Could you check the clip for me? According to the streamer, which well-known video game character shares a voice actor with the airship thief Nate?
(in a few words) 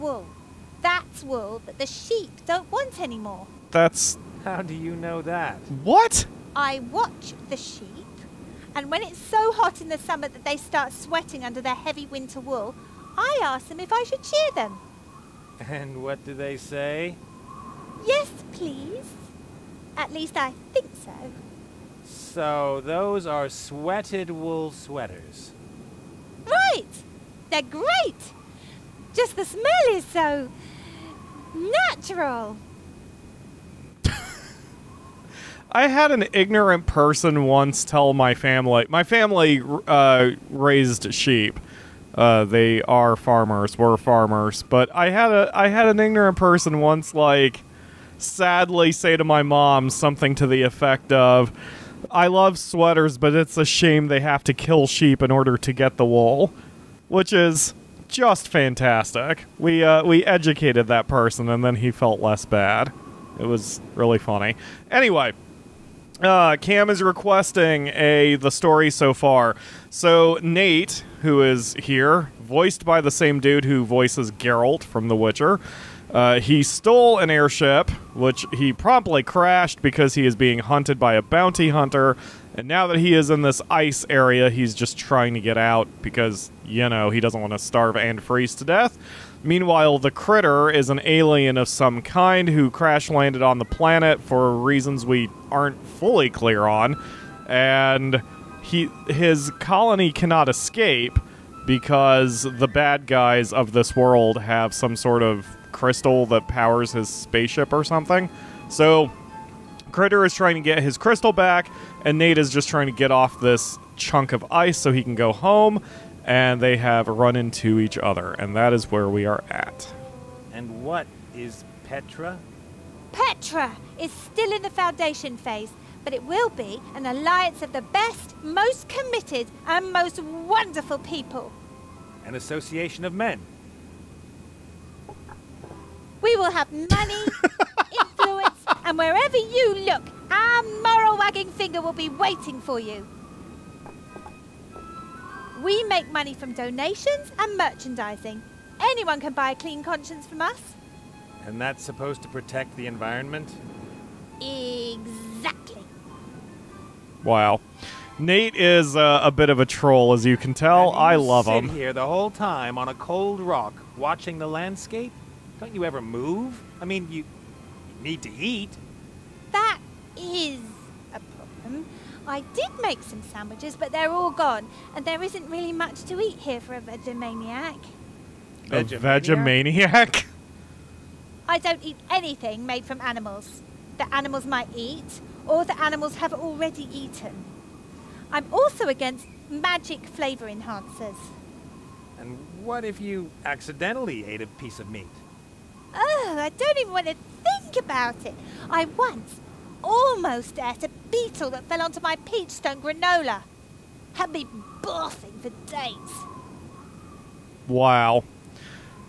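Geralt.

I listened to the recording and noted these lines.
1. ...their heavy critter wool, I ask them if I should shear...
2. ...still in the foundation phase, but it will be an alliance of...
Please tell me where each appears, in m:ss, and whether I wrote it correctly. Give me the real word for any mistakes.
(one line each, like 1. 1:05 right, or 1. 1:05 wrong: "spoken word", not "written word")
1. 0:11 wrong: "winter", not "critter"
2. 2:04 right.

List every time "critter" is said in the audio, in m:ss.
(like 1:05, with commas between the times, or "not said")
1:30, 1:49.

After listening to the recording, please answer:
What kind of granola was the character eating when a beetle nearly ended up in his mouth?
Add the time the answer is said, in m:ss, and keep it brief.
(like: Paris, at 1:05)
peach stone granola, at 3:22.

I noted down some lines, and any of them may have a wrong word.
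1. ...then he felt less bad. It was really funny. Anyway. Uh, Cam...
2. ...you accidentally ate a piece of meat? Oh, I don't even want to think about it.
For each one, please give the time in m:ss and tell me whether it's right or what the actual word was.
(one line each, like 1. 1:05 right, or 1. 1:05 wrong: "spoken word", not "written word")
1. 1:01 right
2. 3:13 right.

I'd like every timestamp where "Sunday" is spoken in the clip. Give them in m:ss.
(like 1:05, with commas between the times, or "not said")
not said.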